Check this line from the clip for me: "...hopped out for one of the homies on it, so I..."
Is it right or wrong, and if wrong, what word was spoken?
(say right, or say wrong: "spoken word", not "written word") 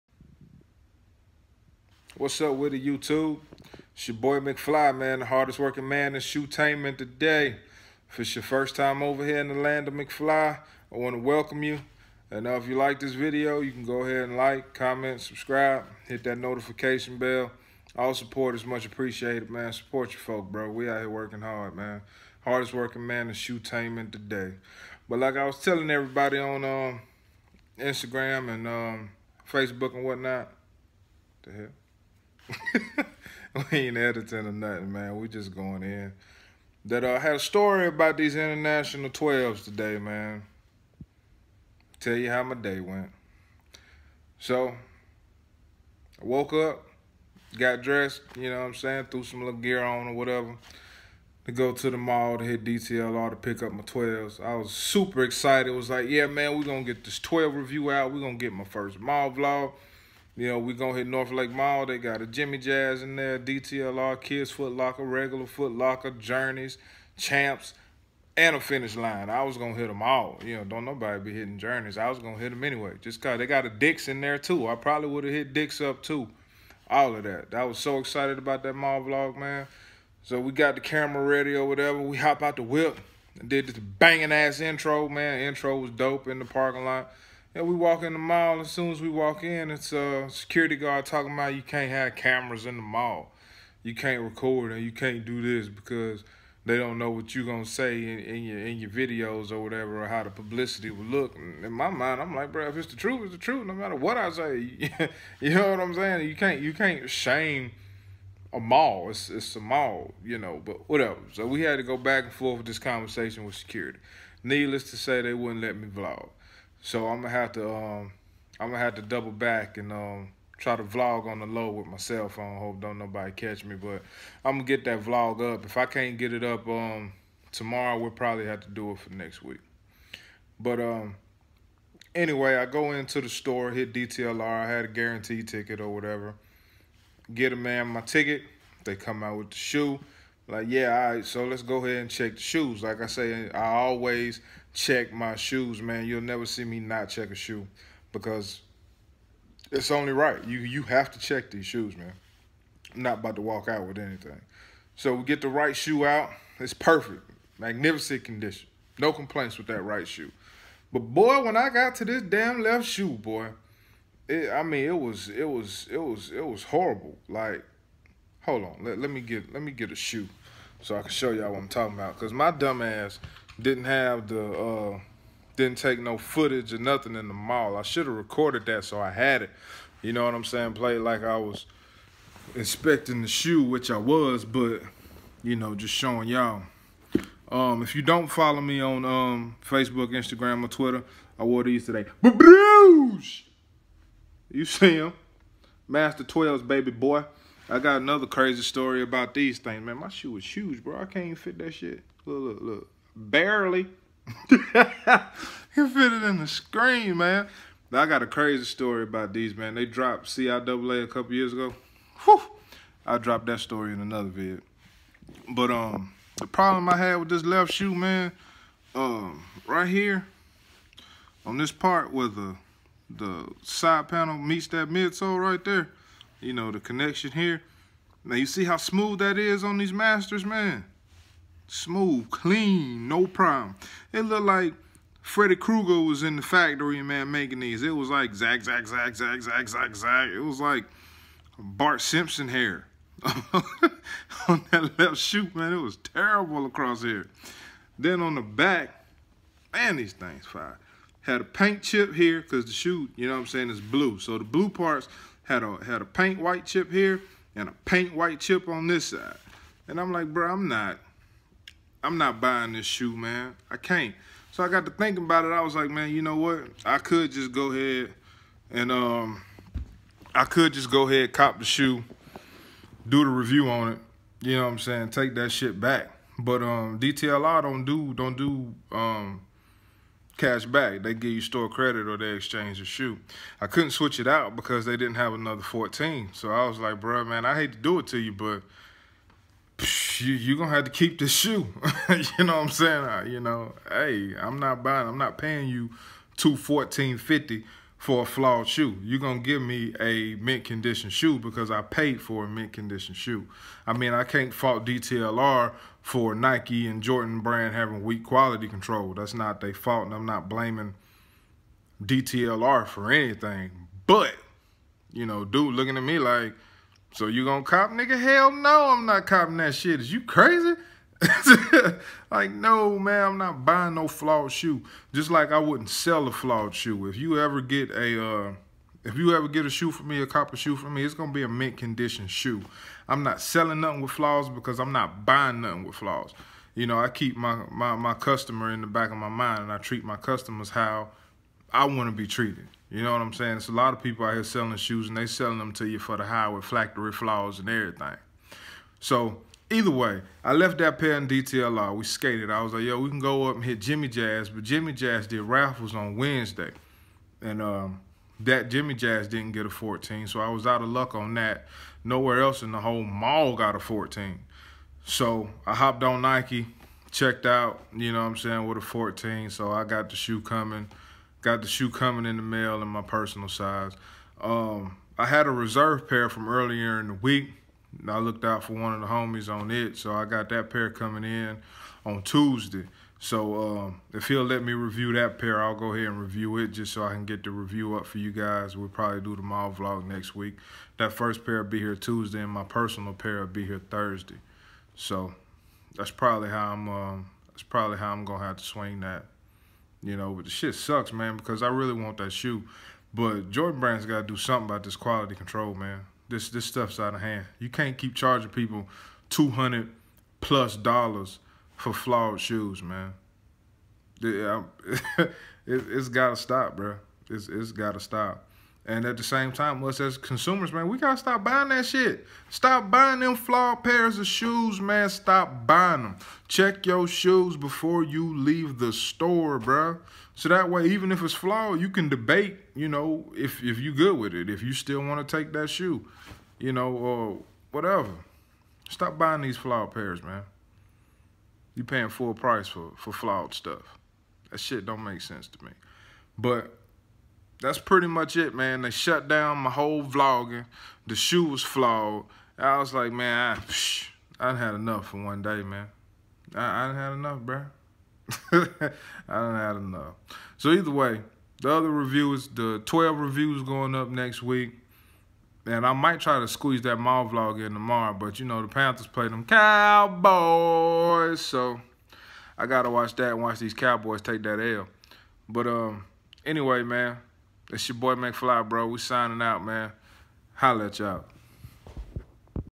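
wrong: "looked", not "hopped".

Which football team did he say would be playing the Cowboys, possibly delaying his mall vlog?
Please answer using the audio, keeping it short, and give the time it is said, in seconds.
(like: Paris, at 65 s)
Panthers, at 468 s.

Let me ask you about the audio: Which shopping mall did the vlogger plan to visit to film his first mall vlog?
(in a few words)
North Lake Mall.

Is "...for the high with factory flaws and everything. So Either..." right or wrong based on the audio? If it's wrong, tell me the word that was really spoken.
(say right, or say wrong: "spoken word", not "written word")
right.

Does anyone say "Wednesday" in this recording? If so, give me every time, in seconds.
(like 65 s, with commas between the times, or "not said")
356 s.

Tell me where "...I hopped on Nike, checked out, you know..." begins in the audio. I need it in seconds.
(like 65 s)
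365 s.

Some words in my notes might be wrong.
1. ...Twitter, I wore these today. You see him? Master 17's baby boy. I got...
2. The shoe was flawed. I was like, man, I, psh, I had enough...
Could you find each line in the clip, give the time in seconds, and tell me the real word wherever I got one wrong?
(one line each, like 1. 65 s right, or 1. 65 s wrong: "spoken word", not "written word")
1. 190 s wrong: "12", not "17"
2. 451 s right.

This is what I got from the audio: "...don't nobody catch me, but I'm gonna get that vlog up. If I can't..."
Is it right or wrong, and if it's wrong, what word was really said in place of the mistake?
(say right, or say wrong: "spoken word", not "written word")
right.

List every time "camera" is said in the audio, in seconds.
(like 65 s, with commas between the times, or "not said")
80 s, 92 s.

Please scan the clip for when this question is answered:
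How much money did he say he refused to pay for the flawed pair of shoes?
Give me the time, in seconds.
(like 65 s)
296 s.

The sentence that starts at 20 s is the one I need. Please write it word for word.
We out here working hard, man.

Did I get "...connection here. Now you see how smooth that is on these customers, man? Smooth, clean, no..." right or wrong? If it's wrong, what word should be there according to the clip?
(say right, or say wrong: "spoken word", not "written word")
wrong: "masters", not "customers".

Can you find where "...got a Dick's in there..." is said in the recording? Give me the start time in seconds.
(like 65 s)
73 s.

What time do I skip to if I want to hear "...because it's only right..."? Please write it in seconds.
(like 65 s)
148 s.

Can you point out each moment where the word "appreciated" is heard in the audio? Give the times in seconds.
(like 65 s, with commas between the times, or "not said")
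18 s.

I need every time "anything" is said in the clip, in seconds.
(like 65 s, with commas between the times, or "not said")
153 s, 313 s.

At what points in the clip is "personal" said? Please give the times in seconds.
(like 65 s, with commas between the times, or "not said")
373 s, 392 s.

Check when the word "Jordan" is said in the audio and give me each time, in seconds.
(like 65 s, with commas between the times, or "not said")
307 s, 403 s.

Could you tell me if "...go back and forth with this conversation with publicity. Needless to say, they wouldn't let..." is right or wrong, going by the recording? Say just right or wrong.
wrong.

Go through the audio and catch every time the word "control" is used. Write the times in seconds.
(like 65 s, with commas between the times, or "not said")
308 s, 405 s.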